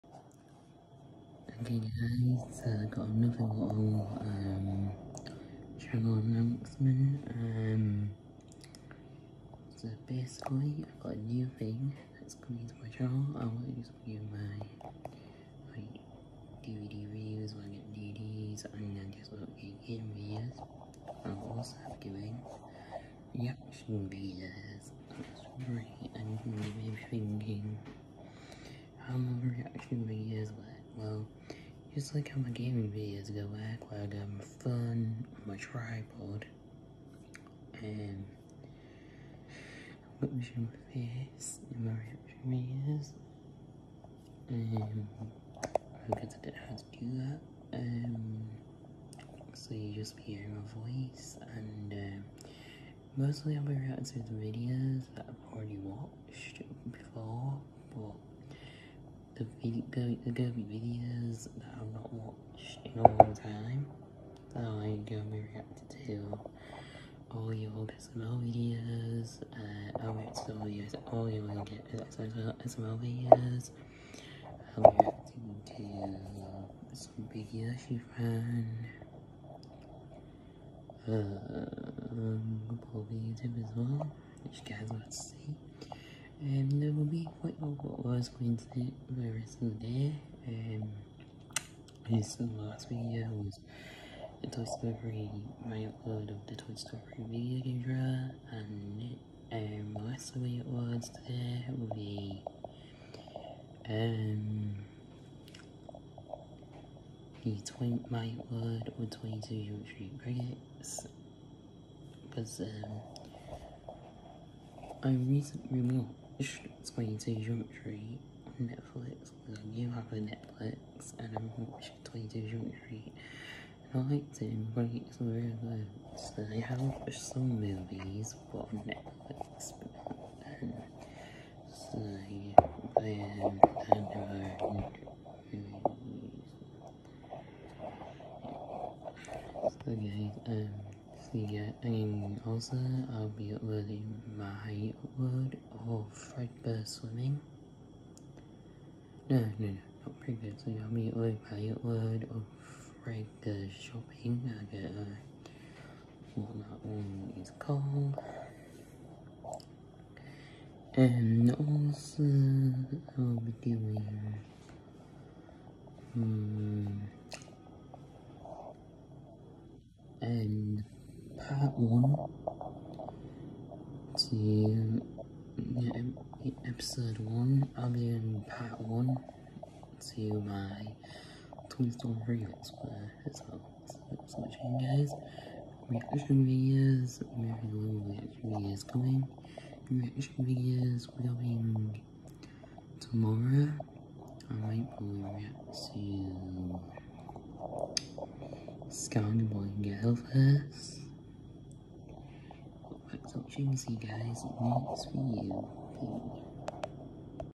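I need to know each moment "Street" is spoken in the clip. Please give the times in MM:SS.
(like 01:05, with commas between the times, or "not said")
01:49, 01:57, 02:02.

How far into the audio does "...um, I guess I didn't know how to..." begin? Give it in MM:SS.
00:45.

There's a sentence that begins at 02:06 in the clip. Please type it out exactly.
So I have watched some movies but on Netflix but, um, so but um, I never movies.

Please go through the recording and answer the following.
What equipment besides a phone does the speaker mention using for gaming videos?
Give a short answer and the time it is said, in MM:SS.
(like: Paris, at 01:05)
tripod, at 00:35.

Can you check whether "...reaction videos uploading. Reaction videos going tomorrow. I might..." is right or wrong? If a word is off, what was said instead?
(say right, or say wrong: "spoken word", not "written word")
wrong: "coming", not "uploading".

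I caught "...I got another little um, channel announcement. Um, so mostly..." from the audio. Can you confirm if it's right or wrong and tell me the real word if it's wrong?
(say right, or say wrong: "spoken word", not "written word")
wrong: "basically", not "mostly".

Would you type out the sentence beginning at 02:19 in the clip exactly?
So guys, um the And also I'll be uploading my word of Fredbear Swimming.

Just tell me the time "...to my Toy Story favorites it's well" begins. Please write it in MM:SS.
03:00.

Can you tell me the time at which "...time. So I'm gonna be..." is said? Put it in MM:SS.
01:03.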